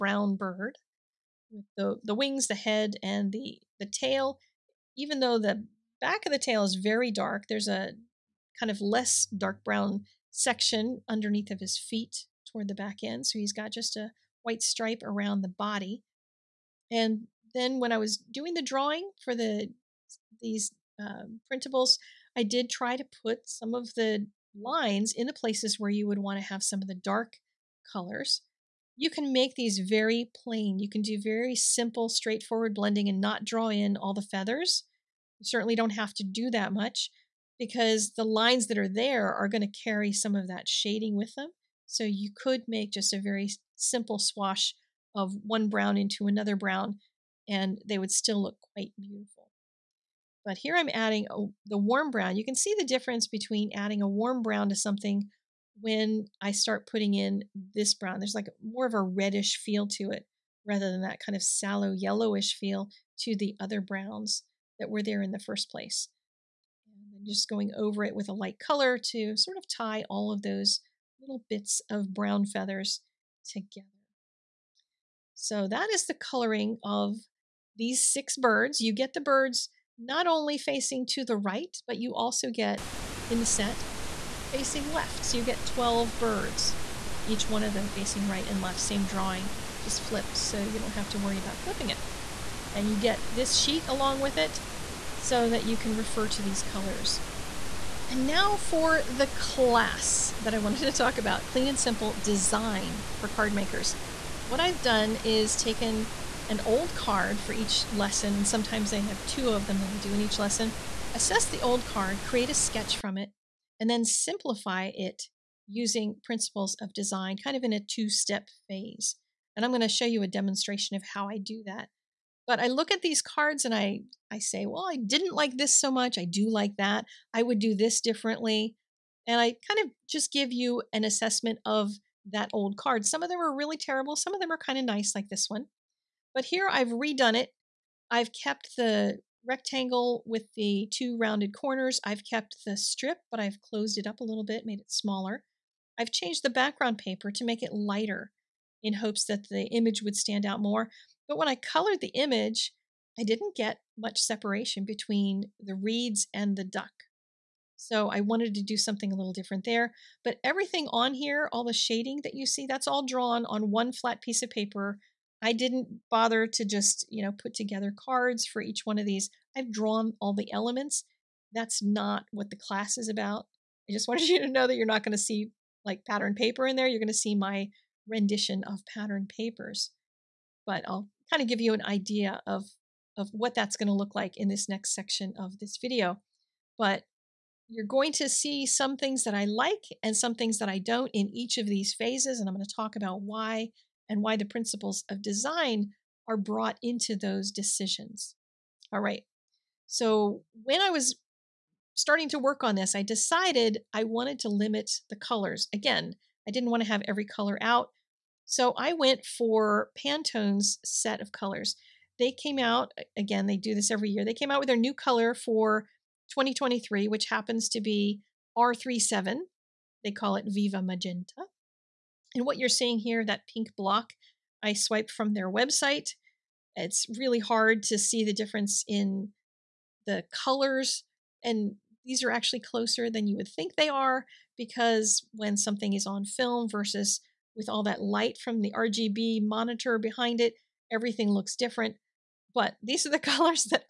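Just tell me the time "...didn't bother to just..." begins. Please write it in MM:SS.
02:45.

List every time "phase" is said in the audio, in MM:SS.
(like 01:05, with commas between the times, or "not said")
01:58, 03:11.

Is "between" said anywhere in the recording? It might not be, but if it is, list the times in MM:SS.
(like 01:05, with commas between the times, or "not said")
00:53, 02:34.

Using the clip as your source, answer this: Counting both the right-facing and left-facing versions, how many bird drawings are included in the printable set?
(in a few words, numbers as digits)
12.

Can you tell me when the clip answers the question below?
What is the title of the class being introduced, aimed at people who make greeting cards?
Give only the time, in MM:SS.
01:41.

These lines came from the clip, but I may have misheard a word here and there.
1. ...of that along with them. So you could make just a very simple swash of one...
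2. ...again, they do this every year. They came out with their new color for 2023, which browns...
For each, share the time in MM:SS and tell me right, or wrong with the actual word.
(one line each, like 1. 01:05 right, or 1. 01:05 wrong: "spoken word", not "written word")
1. 00:40 wrong: "shading", not "along"
2. 03:33 wrong: "happens", not "browns".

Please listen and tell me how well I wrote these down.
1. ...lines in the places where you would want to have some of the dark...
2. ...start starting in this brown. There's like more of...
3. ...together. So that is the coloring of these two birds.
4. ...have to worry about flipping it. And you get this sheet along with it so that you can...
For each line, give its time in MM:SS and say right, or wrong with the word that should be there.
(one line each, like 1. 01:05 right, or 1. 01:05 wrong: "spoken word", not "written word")
1. 00:24 right
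2. 00:56 wrong: "putting", not "starting"
3. 01:13 wrong: "six", not "two"
4. 01:30 right.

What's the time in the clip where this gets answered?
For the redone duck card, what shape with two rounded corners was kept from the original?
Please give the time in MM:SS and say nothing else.
02:19.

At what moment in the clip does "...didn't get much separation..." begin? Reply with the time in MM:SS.
02:33.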